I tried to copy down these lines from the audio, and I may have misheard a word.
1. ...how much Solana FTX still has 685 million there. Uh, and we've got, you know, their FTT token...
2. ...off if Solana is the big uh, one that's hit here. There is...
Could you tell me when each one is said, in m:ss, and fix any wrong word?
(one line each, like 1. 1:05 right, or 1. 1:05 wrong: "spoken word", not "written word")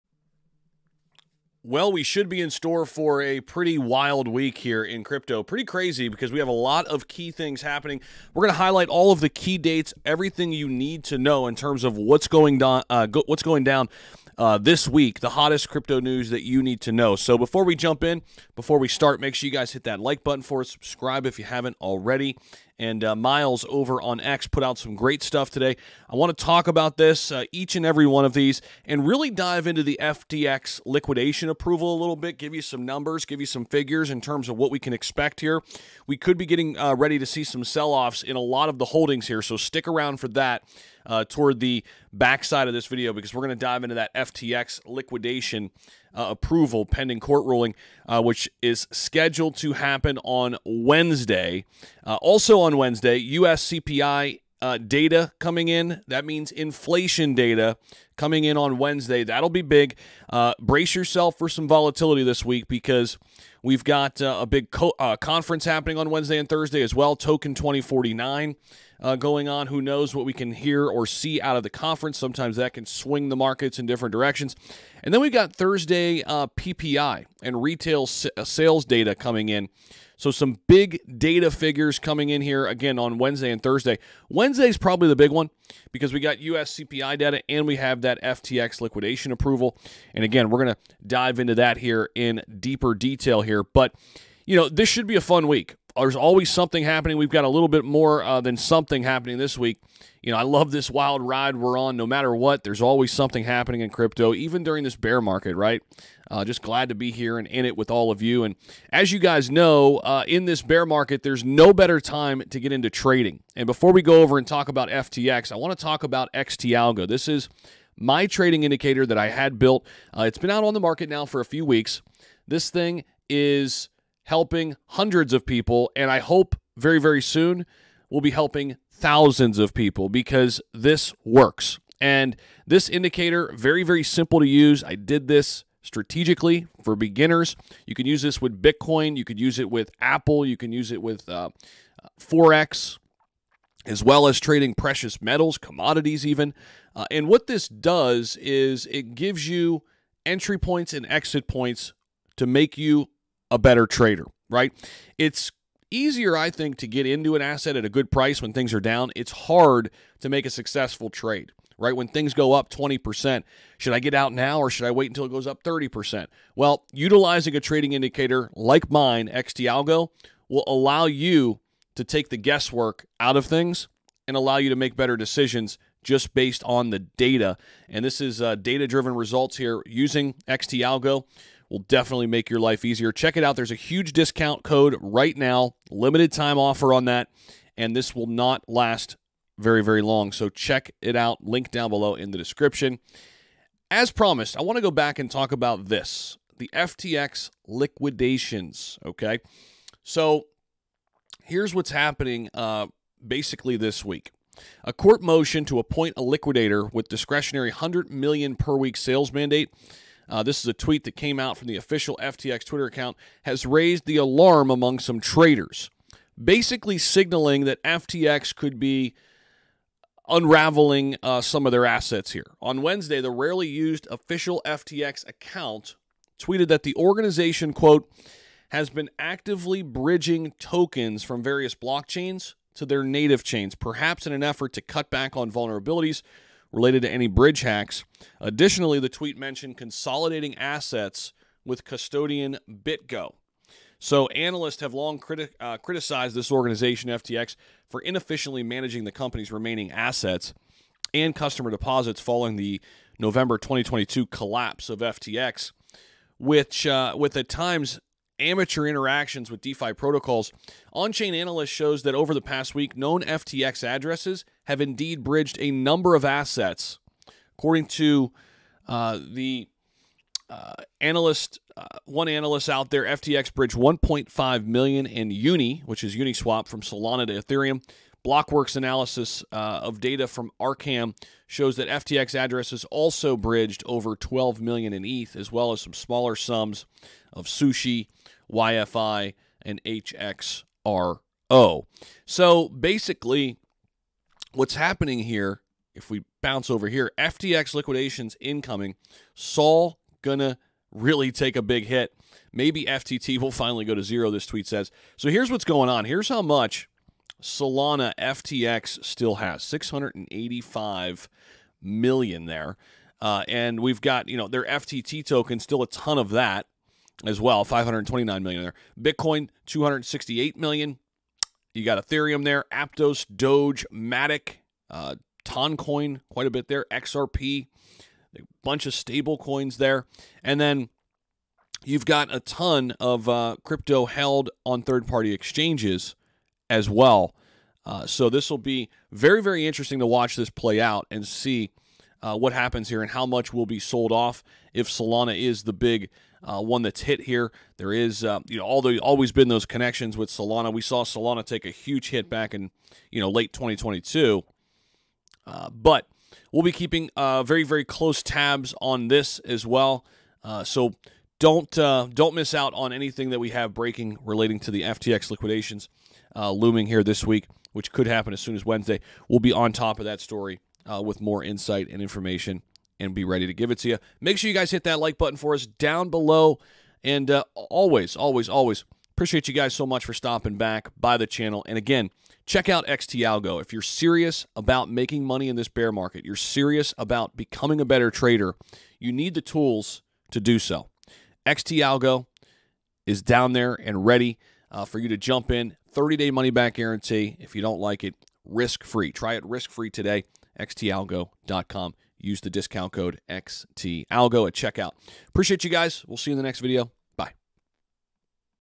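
1. 5:06 right
2. 5:44 right.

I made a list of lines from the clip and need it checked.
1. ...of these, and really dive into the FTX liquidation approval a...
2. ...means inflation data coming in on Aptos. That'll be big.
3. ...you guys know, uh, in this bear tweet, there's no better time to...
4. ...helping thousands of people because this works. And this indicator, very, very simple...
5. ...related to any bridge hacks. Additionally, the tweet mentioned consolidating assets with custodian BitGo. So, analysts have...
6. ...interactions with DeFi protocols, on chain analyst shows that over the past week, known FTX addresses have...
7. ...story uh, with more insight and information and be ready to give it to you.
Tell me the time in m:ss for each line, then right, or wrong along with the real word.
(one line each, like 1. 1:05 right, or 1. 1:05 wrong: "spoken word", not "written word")
1. 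0:28 right
2. 0:56 wrong: "Wednesday", not "Aptos"
3. 1:49 wrong: "market", not "tweet"
4. 2:08 right
5. 3:56 right
6. 4:18 right
7. 6:10 right.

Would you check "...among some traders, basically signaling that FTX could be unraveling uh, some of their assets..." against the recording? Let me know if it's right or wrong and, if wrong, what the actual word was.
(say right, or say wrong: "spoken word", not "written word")
right.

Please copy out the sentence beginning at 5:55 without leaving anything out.
Uh, but We'll be keeping uh, very, very close tabs on this as well.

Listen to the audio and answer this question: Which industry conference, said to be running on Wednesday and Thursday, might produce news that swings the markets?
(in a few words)
Token 2049.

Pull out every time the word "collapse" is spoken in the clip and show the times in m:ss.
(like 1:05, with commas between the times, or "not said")
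4:14.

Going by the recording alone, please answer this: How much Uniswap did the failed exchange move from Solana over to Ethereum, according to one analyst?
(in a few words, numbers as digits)
$1.5 million.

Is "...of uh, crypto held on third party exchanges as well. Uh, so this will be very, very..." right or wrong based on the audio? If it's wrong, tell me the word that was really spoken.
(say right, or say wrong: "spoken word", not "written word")
right.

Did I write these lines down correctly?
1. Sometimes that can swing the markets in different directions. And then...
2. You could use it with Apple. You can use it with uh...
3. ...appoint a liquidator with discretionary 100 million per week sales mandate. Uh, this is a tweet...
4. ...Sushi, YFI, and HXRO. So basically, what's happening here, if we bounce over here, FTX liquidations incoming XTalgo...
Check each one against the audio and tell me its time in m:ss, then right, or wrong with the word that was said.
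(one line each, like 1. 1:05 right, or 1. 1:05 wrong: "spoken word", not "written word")
1. 1:12 right
2. 2:19 right
3. 3:25 right
4. 4:47 wrong: "Sol", not "XTalgo".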